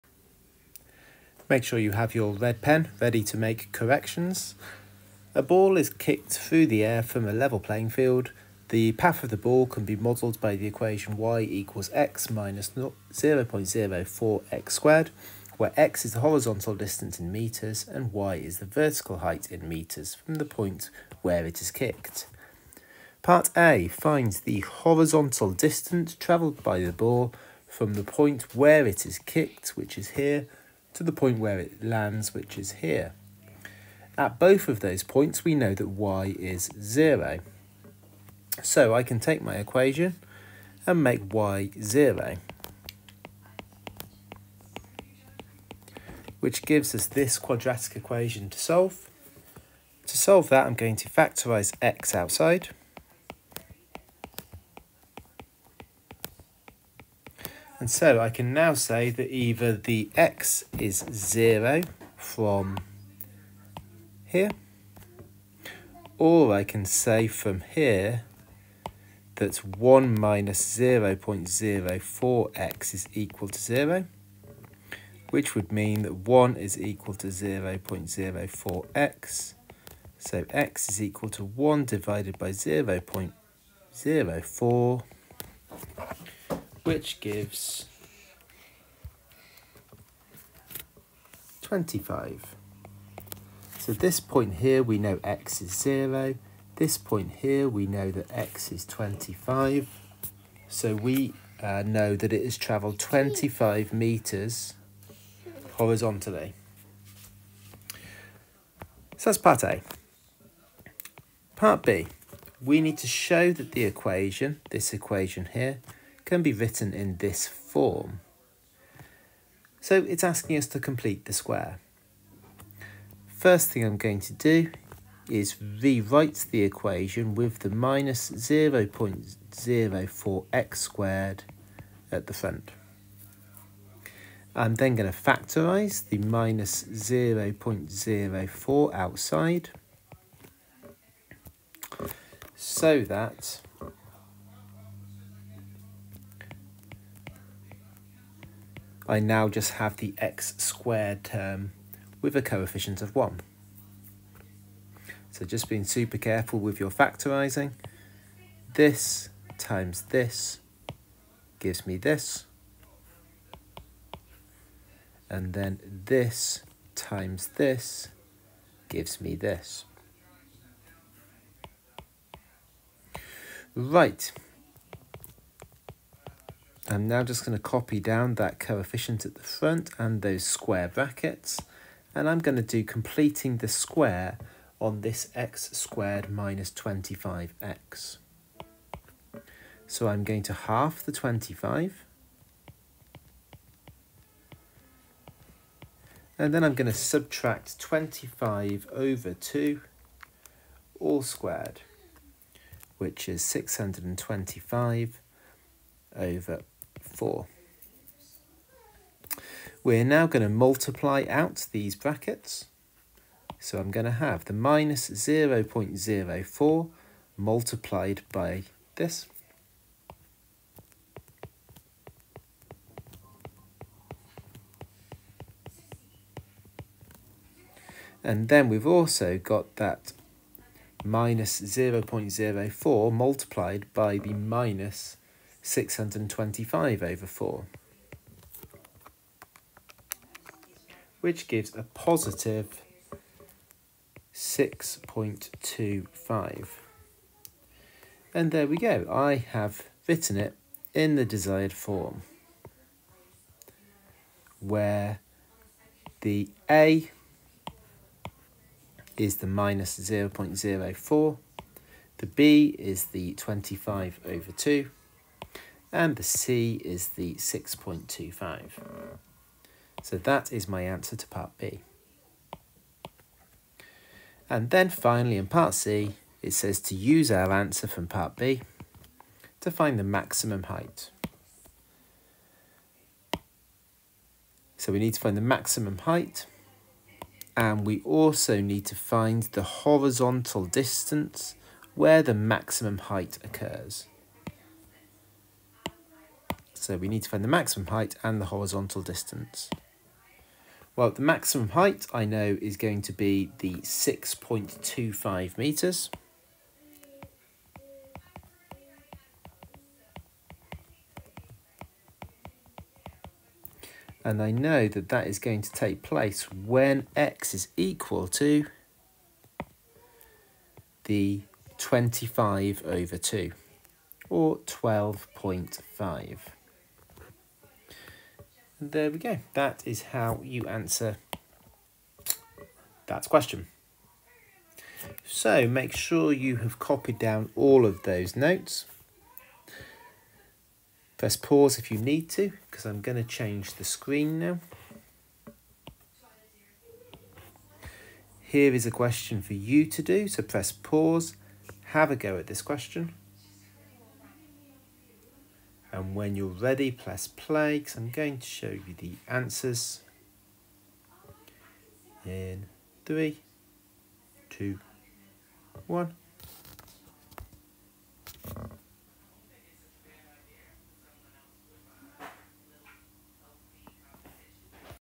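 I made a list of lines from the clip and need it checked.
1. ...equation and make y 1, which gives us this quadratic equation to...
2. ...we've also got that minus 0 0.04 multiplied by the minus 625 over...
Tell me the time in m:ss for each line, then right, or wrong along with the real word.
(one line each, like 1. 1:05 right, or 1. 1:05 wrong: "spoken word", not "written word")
1. 0:39 wrong: "0", not "1"
2. 3:48 right.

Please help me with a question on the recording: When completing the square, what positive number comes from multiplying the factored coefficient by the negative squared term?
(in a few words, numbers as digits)
6.25.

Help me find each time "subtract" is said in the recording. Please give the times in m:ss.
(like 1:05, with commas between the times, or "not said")
3:16.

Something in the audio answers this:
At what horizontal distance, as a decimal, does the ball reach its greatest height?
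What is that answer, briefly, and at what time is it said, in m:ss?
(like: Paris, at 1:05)
12.5, at 5:24.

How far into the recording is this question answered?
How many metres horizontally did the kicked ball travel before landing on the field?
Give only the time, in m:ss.
1:42.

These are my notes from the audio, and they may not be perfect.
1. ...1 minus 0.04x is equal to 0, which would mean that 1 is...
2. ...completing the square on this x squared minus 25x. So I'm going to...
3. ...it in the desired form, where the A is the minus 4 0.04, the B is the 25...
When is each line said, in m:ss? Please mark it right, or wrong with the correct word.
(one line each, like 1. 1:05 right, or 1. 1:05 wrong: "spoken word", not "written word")
1. 1:09 right
2. 3:02 right
3. 4:10 wrong: "0", not "4".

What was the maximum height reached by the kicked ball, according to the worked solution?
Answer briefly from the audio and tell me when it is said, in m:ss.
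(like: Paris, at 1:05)
6.25 metres, at 5:03.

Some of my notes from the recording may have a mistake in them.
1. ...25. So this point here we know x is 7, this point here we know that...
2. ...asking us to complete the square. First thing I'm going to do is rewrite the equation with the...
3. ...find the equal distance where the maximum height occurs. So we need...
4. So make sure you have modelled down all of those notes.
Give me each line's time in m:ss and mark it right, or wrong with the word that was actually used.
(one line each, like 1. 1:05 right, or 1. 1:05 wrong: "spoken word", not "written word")
1. 1:31 wrong: "0", not "7"
2. 2:00 right
3. 4:48 wrong: "horizontal", not "equal"
4. 5:35 wrong: "copied", not "modelled".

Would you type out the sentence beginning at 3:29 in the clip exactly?
We're now going to multiply out these brackets.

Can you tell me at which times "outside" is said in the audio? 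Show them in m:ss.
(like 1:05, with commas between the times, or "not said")
0:52, 2:18.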